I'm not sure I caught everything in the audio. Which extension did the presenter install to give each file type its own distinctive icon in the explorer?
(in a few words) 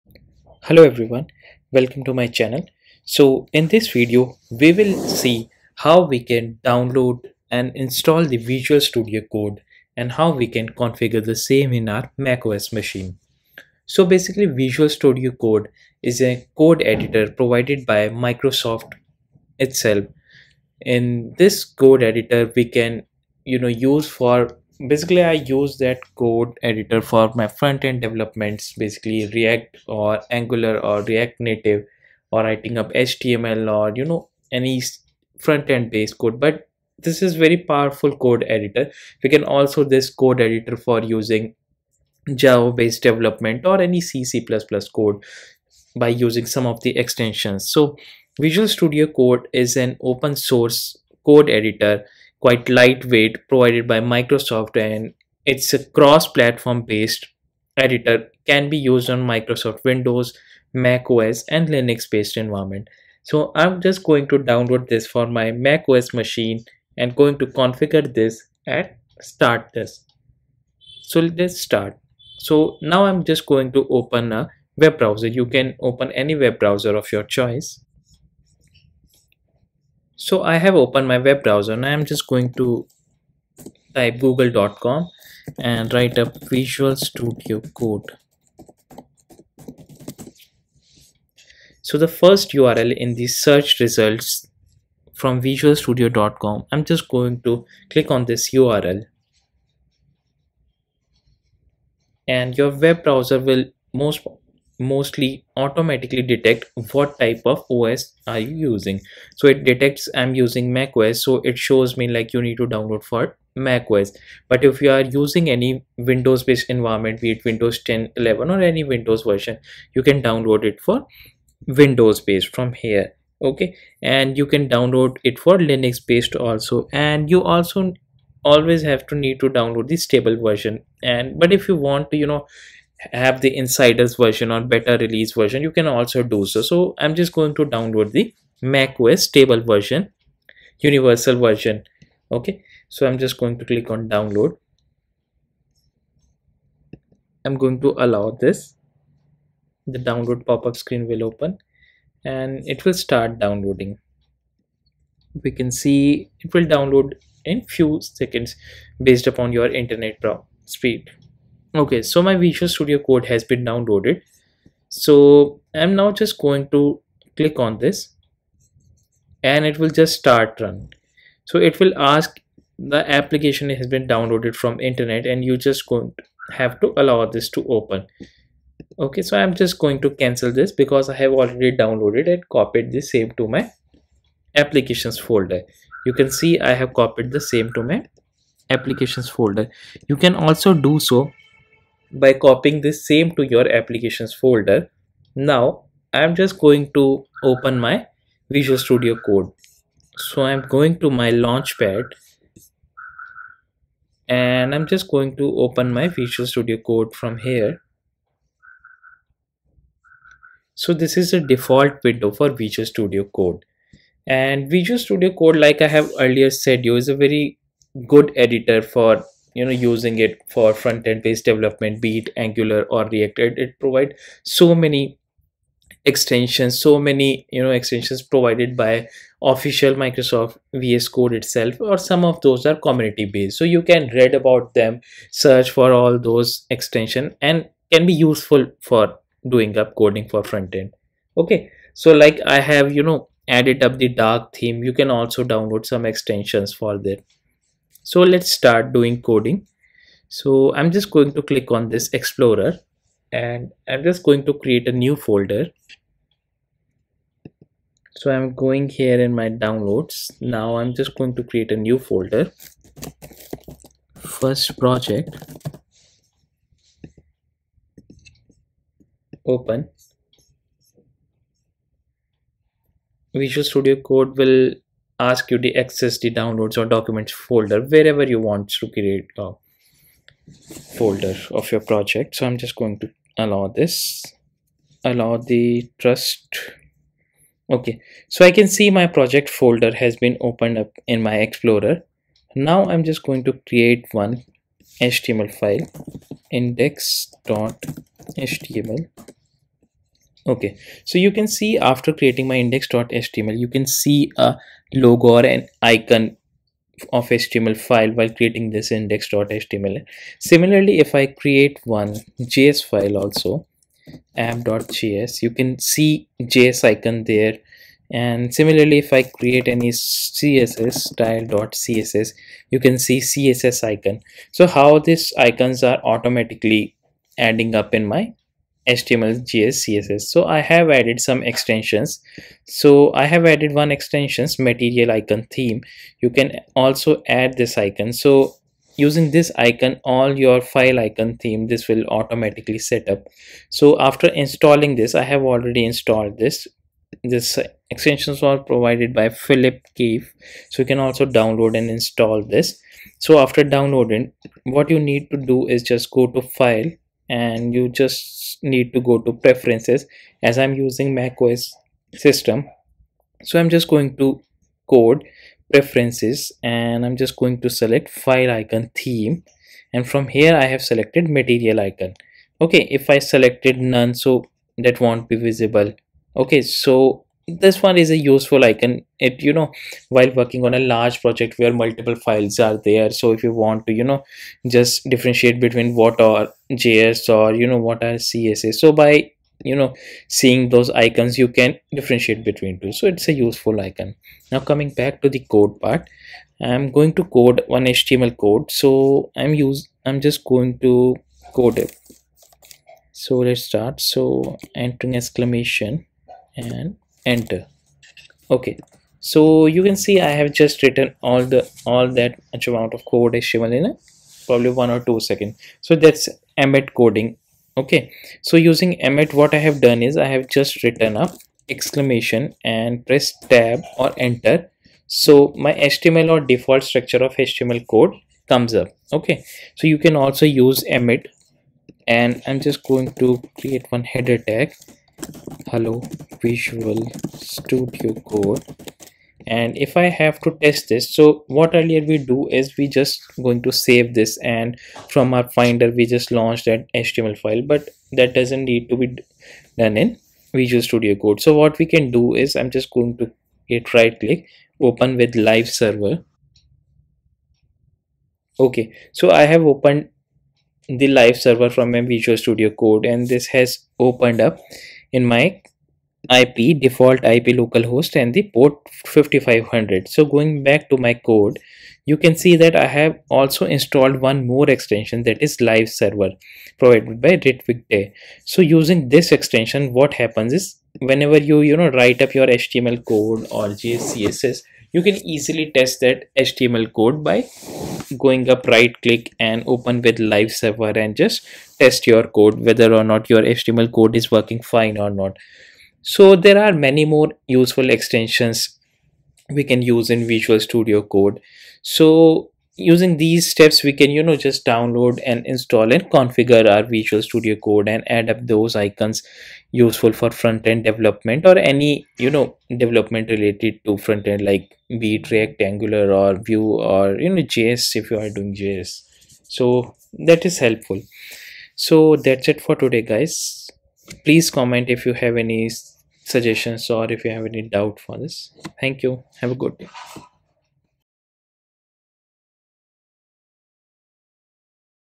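material icon theme.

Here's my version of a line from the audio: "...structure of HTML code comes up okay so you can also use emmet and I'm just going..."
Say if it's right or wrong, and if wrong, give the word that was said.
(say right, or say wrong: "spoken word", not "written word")
right.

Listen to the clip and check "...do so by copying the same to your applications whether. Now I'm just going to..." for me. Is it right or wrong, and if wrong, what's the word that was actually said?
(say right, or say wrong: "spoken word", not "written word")
wrong: "folder", not "whether".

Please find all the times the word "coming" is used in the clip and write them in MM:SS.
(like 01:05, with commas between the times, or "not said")
06:34.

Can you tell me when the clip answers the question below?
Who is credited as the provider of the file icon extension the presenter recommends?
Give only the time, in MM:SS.
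05:49.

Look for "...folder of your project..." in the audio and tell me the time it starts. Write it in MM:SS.
04:40.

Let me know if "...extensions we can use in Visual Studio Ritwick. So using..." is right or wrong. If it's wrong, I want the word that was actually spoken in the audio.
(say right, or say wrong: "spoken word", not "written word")
wrong: "Code", not "Ritwick".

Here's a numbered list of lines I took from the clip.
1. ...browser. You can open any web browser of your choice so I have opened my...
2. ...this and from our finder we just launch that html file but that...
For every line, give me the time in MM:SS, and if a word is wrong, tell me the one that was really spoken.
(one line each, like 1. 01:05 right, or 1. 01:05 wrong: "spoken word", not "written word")
1. 01:14 right
2. 07:24 right.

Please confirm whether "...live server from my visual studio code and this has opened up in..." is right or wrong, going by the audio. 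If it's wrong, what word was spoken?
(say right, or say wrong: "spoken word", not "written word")
right.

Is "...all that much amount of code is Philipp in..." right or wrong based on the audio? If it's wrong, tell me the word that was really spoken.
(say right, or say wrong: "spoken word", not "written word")
wrong: "Shivan", not "Philipp".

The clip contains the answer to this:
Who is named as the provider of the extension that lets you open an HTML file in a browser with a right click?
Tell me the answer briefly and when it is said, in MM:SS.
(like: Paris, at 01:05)
Ritwick Dey, at 07:57.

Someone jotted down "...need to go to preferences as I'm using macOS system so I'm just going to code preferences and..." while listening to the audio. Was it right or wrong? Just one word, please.
right.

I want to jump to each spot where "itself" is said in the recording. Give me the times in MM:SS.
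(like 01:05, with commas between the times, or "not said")
00:19, 03:51.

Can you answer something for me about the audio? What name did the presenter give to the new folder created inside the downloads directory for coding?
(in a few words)
First project.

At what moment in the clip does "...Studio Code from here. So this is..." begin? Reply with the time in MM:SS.
03:26.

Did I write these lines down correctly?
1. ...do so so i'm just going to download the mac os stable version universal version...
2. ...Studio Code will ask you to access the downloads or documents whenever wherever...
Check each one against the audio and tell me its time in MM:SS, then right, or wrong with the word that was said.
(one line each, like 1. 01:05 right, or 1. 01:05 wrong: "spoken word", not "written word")
1. 02:16 right
2. 04:33 wrong: "folder", not "whenever".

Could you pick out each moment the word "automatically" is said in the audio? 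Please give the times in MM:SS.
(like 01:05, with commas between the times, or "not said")
01:45, 05:26, 05:42.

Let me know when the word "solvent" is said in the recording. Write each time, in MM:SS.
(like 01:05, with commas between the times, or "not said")
not said.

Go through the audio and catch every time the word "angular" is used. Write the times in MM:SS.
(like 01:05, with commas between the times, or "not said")
00:30, 03:42, 08:35.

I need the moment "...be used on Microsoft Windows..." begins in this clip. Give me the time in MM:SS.
00:58.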